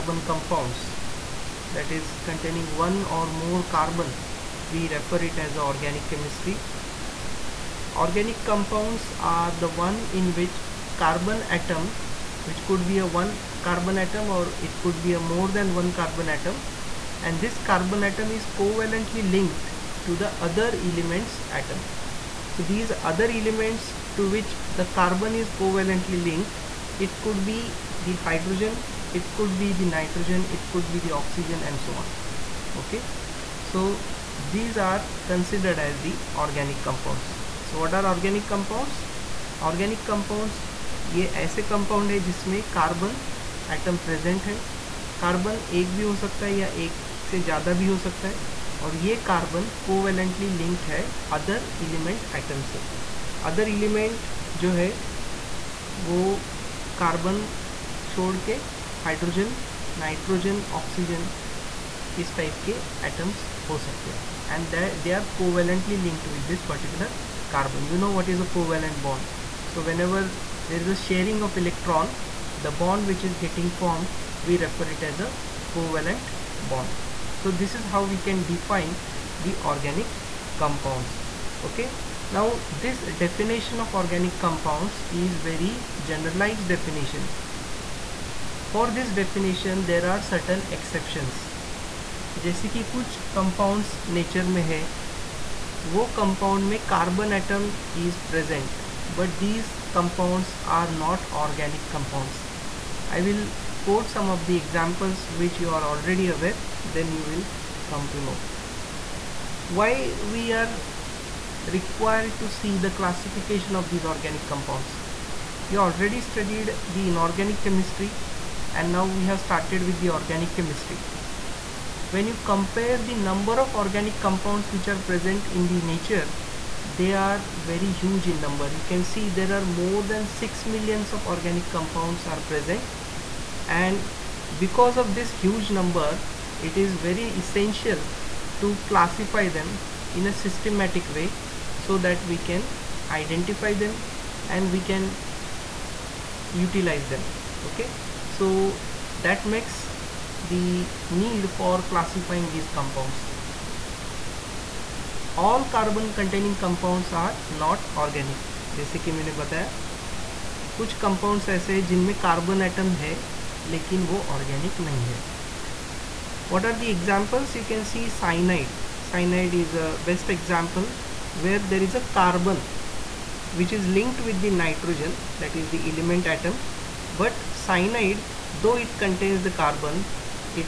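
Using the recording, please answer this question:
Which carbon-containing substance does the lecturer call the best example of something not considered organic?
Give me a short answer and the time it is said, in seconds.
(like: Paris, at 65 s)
cyanide, at 169 s.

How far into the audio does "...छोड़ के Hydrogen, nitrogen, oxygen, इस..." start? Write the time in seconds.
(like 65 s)
58 s.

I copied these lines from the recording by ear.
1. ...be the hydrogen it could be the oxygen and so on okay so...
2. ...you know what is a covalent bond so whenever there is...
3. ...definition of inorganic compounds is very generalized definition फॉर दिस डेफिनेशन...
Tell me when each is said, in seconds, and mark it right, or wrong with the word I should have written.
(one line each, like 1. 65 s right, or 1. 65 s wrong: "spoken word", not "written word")
1. 29 s wrong: "nitrogen", not "hydrogen"
2. 67 s right
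3. 83 s wrong: "organic", not "inorganic".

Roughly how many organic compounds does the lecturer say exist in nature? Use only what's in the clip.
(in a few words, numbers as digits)
more than 6 million.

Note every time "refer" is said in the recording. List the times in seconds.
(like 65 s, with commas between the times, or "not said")
4 s, 74 s.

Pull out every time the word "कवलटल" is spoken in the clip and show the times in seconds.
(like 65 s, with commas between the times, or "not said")
49 s, 65 s.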